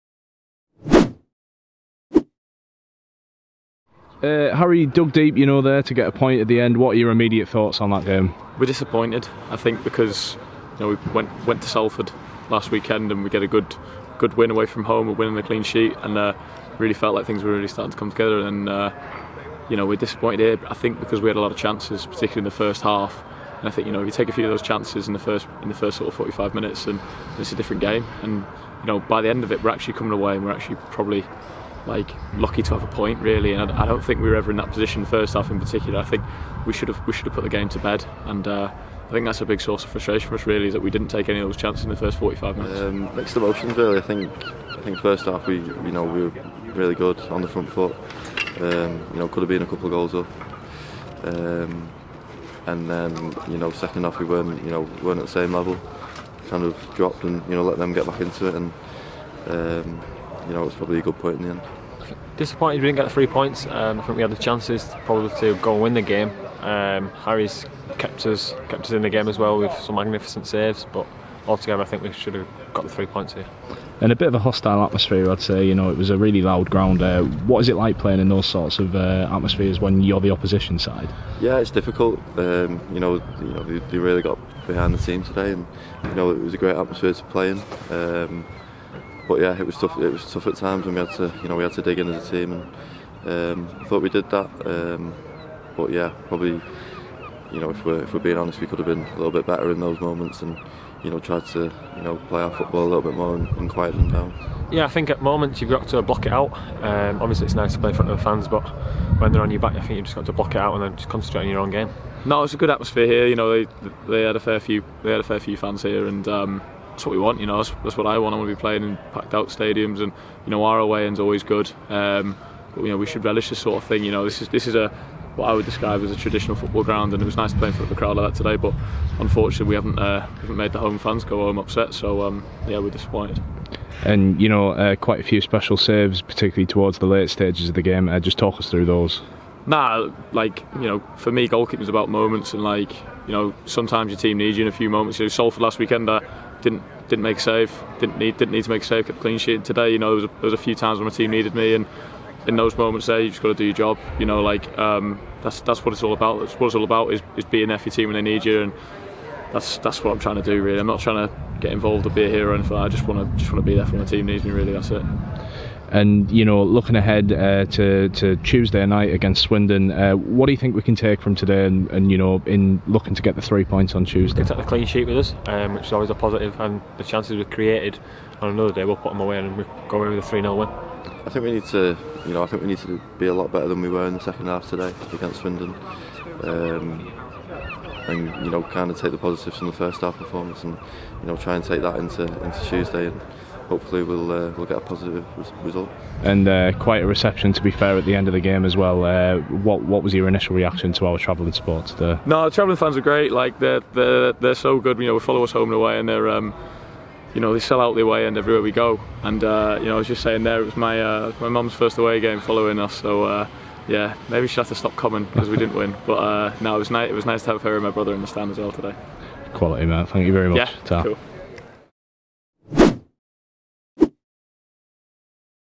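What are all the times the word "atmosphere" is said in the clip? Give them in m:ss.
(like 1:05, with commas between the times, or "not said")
1:14, 1:19, 1:26, 1:52.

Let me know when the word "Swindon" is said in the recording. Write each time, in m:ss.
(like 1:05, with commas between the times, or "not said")
2:49, 3:05.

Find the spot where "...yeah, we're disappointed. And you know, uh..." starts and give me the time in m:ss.
2:12.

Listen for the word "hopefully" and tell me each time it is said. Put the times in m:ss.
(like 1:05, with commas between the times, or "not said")
3:13.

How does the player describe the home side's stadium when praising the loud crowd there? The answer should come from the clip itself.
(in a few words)
A traditional football ground.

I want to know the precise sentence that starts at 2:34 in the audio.
You know, like um, that's that's what it's all about.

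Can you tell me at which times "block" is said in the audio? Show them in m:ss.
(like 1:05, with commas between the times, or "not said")
1:46, 1:50.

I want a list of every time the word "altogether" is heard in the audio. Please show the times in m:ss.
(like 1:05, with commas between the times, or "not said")
1:11.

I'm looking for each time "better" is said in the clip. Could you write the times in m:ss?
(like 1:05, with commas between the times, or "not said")
1:39, 3:03.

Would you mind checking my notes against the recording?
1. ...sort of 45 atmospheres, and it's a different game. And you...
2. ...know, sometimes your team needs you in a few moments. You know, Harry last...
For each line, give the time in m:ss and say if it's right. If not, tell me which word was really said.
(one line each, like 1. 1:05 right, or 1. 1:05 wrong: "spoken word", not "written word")
1. 0:25 wrong: "minutes", not "atmospheres"
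2. 2:23 wrong: "Salford", not "Harry".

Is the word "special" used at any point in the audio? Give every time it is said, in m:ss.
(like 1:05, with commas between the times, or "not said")
2:15.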